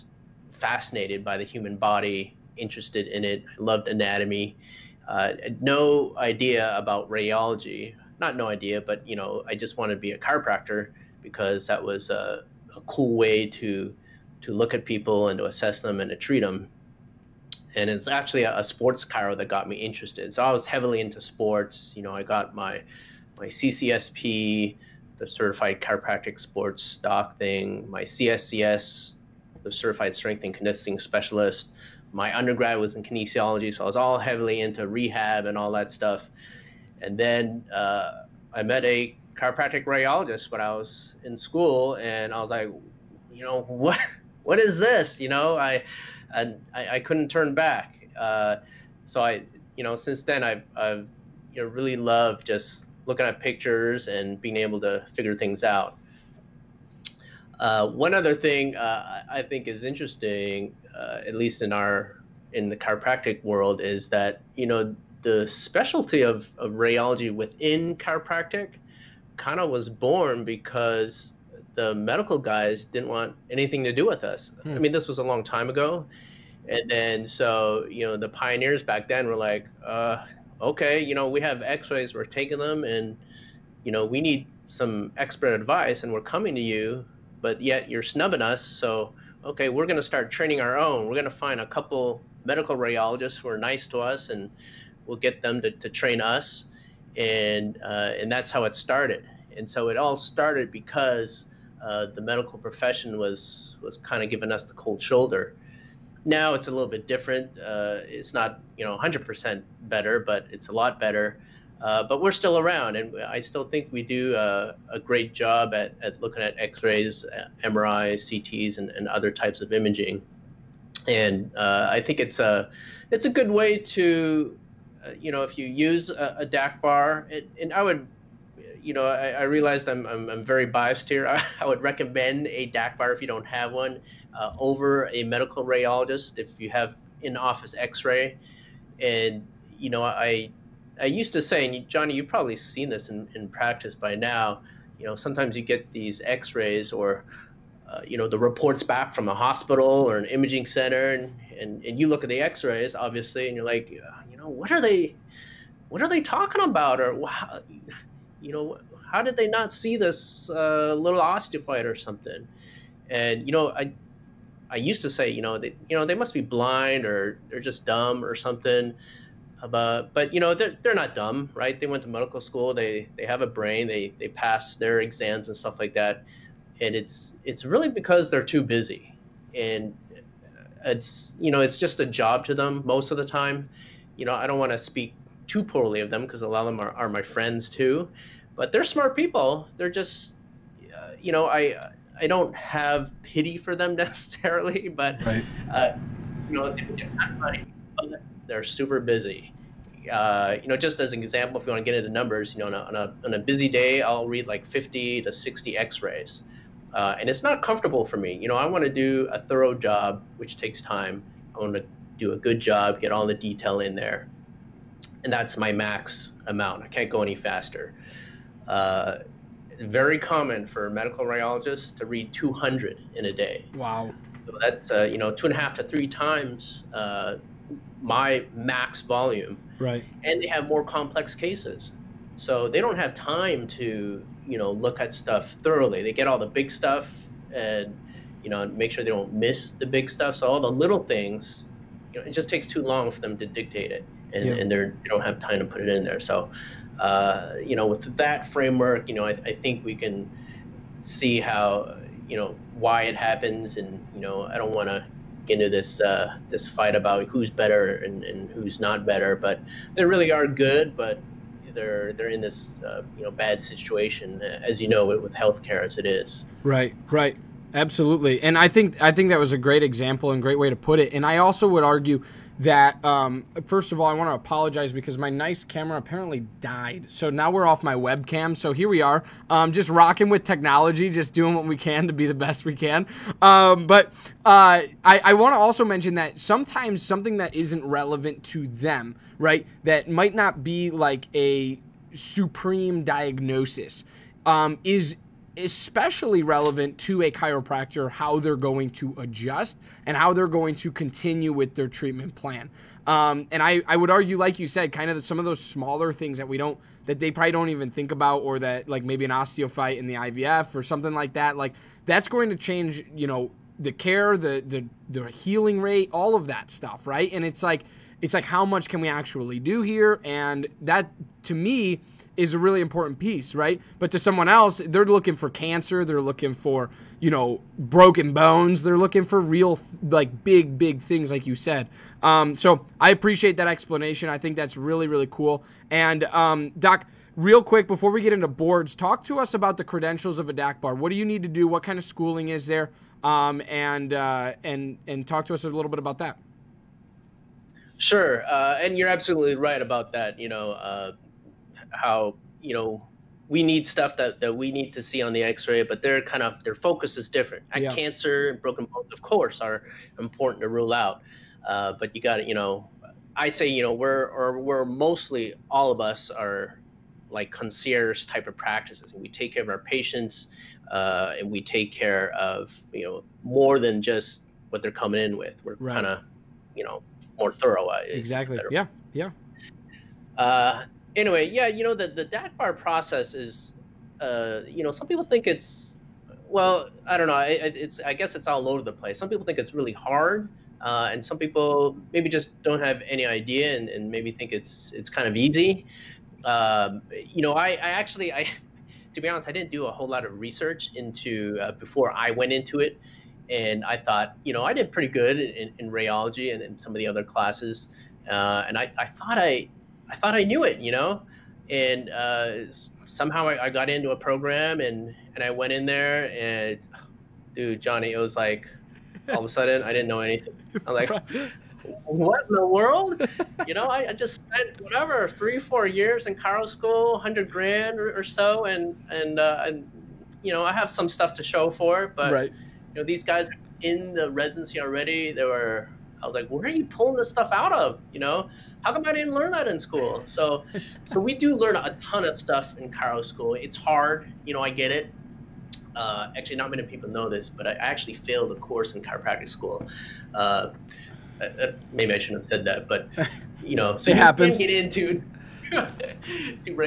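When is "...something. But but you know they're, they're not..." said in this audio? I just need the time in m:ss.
2:48.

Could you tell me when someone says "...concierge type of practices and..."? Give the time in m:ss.
6:07.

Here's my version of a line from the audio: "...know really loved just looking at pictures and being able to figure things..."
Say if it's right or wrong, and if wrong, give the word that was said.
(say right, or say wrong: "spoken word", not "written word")
right.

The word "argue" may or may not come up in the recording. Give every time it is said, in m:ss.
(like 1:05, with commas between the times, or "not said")
4:31, 5:04.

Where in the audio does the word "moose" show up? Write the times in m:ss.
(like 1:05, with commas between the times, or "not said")
not said.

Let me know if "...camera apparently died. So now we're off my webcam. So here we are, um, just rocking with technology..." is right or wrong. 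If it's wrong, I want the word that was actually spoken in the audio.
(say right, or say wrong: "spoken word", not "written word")
right.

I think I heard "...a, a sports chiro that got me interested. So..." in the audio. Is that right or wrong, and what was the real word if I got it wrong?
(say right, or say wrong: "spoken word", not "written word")
right.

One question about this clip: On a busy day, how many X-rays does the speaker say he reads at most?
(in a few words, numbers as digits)
50 to 60.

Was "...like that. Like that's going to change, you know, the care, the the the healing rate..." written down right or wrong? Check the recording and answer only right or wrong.
right.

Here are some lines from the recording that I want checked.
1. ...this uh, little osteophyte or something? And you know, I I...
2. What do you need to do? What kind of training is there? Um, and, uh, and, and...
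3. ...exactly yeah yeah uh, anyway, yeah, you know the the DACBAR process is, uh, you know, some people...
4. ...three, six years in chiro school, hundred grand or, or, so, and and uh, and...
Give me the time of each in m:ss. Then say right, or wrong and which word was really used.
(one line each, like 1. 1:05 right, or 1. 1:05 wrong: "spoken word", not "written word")
1. 2:39 right
2. 5:40 wrong: "schooling", not "training"
3. 6:18 right
4. 7:05 wrong: "four", not "six".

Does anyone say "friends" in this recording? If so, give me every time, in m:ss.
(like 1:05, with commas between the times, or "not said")
3:07.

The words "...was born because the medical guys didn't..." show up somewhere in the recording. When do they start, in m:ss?
1:09.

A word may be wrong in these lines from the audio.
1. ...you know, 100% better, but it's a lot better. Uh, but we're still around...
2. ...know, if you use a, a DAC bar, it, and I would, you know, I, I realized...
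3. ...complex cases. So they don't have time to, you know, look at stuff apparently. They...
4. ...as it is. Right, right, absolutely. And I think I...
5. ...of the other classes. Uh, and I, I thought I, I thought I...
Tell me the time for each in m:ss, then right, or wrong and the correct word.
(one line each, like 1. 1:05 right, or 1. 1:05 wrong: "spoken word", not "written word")
1. 1:48 right
2. 2:05 right
3. 3:50 wrong: "thoroughly", not "apparently"
4. 4:25 right
5. 6:46 right.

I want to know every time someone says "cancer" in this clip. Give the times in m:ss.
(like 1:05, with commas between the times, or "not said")
5:25, 5:57.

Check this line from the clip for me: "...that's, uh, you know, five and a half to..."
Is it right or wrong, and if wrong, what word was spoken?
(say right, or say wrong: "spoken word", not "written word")
wrong: "two", not "five".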